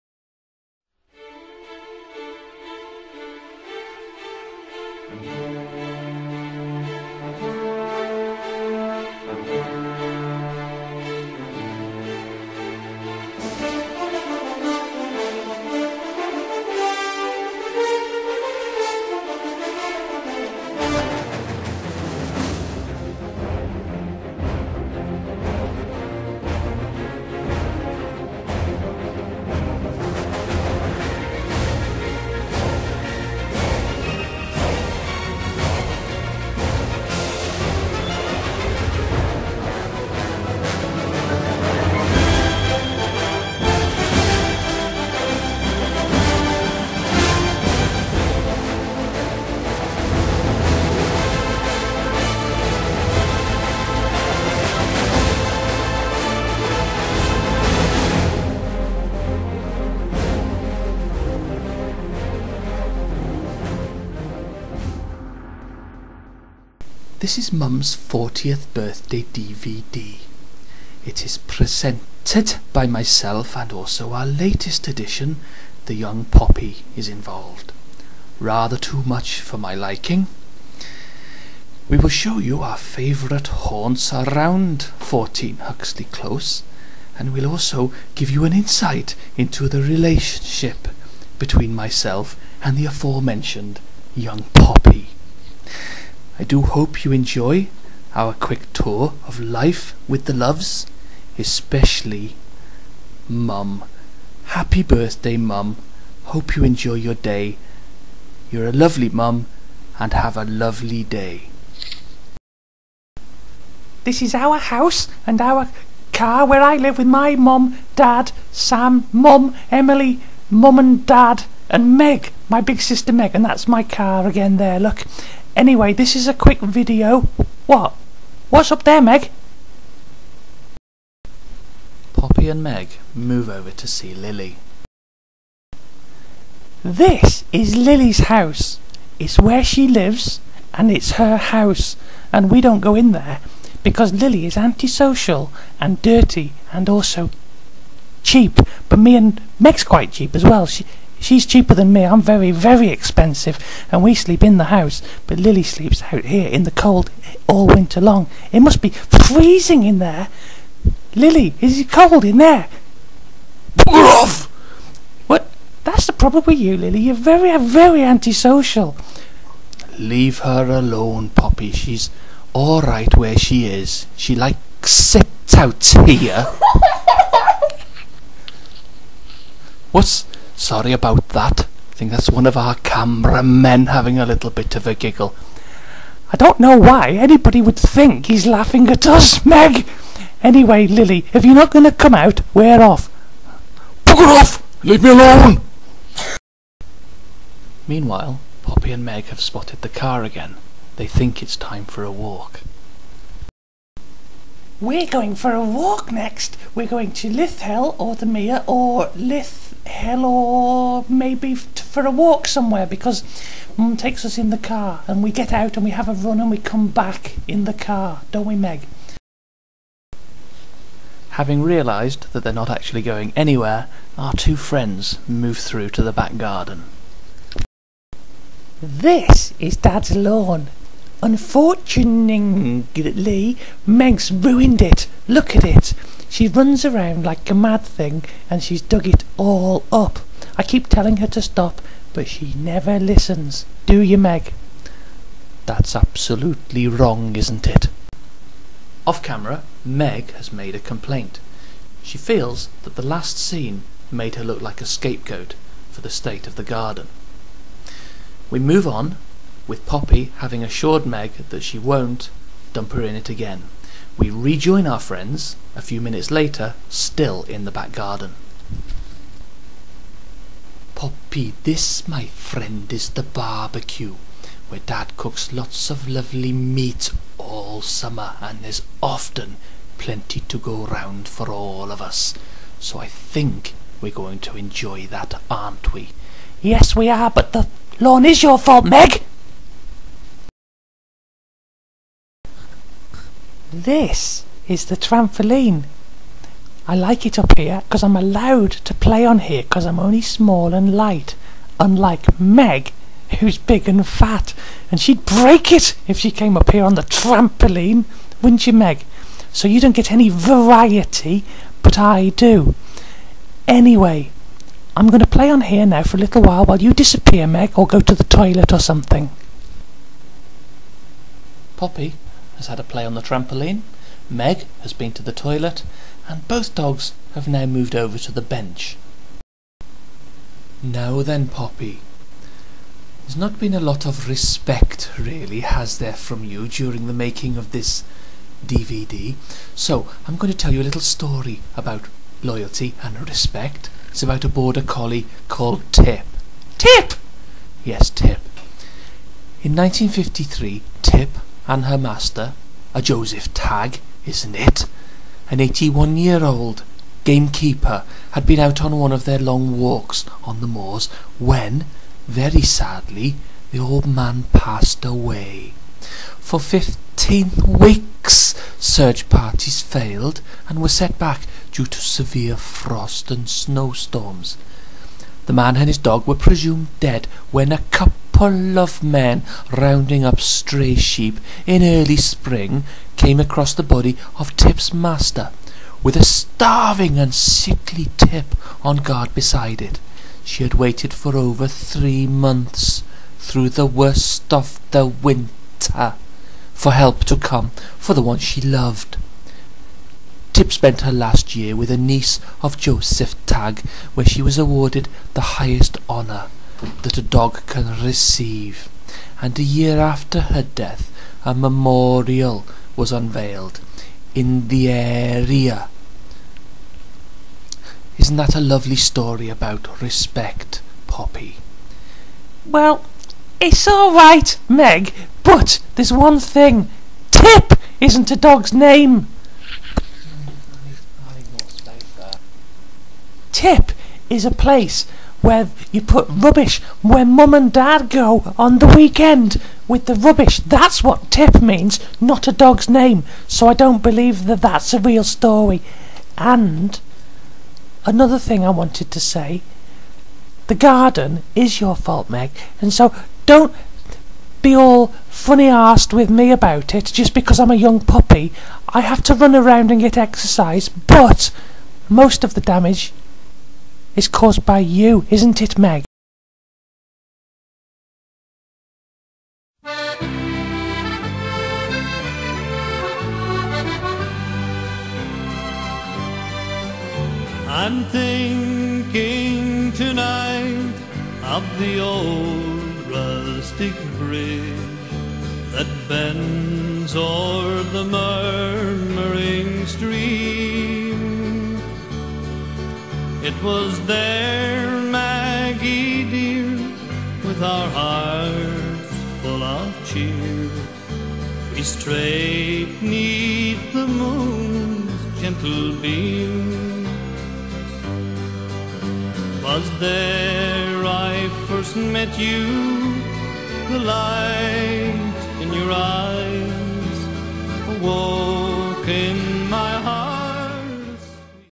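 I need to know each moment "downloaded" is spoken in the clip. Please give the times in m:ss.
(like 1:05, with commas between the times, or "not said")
not said.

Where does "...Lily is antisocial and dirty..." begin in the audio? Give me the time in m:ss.
2:24.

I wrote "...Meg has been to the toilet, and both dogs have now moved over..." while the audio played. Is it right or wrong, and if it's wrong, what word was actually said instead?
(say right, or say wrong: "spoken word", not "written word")
right.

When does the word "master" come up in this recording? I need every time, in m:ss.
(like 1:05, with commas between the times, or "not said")
5:51, 6:24.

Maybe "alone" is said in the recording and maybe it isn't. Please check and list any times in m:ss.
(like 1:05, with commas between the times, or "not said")
2:50, 3:15.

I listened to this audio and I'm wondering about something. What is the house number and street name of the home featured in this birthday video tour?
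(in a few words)
14 Huxley Close.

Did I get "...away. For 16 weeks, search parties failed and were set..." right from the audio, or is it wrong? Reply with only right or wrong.
wrong.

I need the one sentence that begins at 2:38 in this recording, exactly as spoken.
It must be freezing in there.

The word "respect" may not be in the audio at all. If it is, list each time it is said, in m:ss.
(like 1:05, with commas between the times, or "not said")
5:34, 5:43, 7:00.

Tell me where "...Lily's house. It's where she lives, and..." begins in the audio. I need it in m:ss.
2:17.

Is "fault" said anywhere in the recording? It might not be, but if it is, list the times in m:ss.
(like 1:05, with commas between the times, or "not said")
4:48, 7:31.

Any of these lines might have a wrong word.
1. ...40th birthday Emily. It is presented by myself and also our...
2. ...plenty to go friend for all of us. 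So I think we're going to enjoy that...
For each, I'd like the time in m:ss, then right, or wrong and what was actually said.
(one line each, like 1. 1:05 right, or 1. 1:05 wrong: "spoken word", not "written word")
1. 1:07 wrong: "DVD", not "Emily"
2. 4:39 wrong: "round", not "friend".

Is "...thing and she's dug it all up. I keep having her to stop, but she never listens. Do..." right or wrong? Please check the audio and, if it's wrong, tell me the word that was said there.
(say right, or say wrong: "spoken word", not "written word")
wrong: "telling", not "having".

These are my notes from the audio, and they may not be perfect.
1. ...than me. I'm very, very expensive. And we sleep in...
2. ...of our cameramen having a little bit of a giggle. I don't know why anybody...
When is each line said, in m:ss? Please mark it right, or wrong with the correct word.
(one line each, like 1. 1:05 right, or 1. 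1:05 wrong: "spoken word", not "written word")
1. 2:31 right
2. 3:02 right.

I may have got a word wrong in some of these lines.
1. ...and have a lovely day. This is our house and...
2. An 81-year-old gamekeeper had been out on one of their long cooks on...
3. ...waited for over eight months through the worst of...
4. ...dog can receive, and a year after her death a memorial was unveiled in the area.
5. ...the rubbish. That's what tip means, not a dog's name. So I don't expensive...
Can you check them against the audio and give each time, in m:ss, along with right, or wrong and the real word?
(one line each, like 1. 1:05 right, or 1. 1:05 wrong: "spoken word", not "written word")
1. 1:49 right
2. 5:55 wrong: "walks", not "cooks"
3. 6:30 wrong: "three", not "eight"
4. 6:47 right
5. 7:20 wrong: "believe", not "expensive".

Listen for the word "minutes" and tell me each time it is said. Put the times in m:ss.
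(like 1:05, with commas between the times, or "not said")
4:26.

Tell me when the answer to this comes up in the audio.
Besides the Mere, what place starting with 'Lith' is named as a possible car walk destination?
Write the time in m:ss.
3:29.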